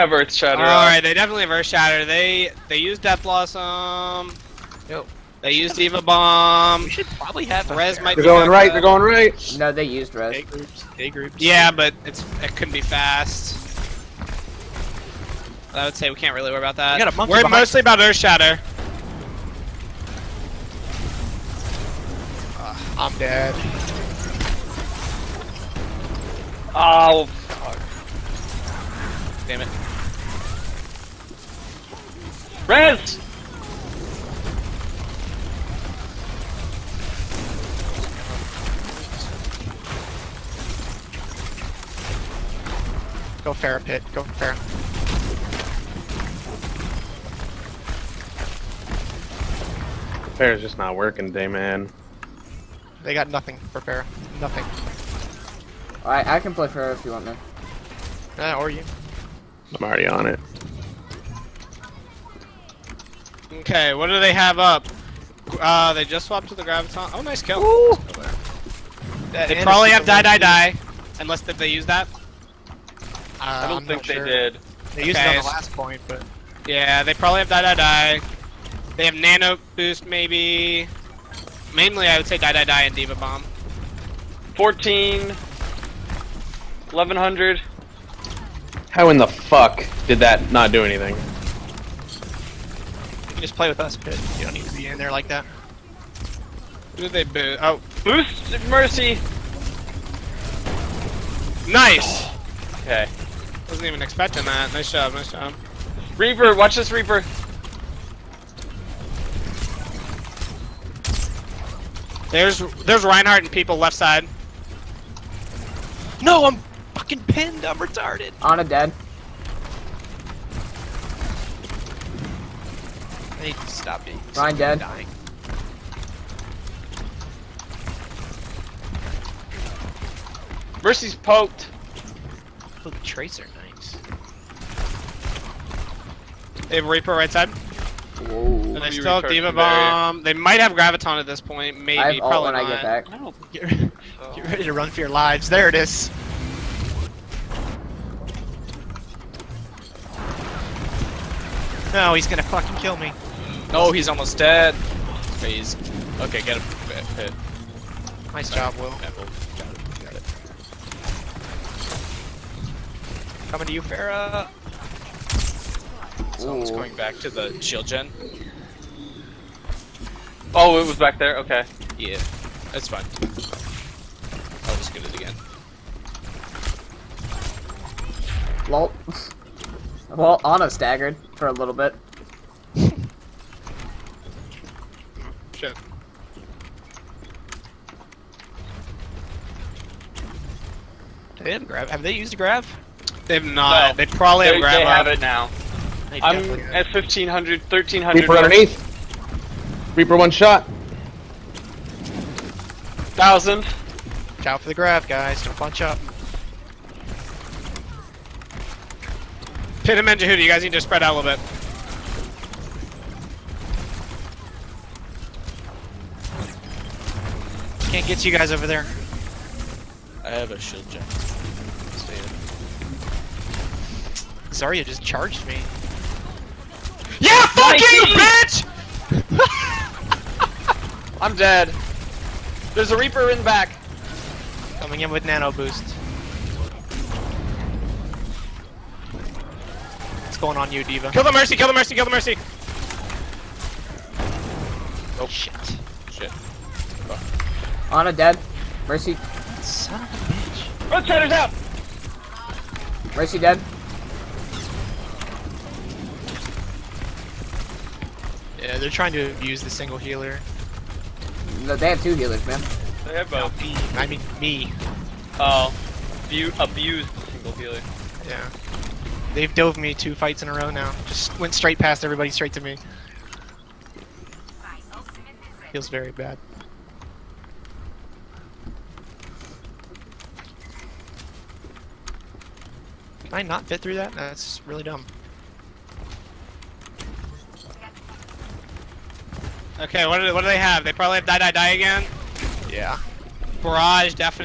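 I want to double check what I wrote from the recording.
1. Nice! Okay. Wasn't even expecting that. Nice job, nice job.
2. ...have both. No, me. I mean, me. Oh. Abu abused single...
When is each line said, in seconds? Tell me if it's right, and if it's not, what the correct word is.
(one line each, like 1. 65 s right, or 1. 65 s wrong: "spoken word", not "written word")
1. 101 s right
2. 263 s right.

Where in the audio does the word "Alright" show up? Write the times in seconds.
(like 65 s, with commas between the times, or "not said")
0 s, 56 s.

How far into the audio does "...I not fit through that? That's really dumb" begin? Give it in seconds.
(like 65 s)
283 s.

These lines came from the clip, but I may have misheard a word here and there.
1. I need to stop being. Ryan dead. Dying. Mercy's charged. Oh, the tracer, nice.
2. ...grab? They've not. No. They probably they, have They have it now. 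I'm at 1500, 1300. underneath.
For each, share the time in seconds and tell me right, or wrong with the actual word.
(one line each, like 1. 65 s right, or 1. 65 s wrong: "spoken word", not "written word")
1. 123 s wrong: "poked", not "charged"
2. 192 s right.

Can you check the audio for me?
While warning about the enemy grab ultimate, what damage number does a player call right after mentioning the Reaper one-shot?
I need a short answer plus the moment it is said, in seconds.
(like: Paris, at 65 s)
1000, at 203 s.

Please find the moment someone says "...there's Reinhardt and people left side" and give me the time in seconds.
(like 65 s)
112 s.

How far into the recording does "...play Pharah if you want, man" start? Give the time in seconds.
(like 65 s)
56 s.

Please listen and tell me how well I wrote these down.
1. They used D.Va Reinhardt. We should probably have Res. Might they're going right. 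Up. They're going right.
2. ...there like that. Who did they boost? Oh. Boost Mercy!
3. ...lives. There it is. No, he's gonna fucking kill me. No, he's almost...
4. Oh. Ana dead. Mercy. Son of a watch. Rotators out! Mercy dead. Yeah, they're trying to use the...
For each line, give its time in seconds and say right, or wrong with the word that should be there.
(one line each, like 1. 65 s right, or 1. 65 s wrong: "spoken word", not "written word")
1. 5 s wrong: "Bomb", not "Reinhardt"
2. 94 s right
3. 145 s right
4. 247 s wrong: "bitch", not "watch".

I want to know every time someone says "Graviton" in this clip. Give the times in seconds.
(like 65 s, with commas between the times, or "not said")
66 s, 140 s.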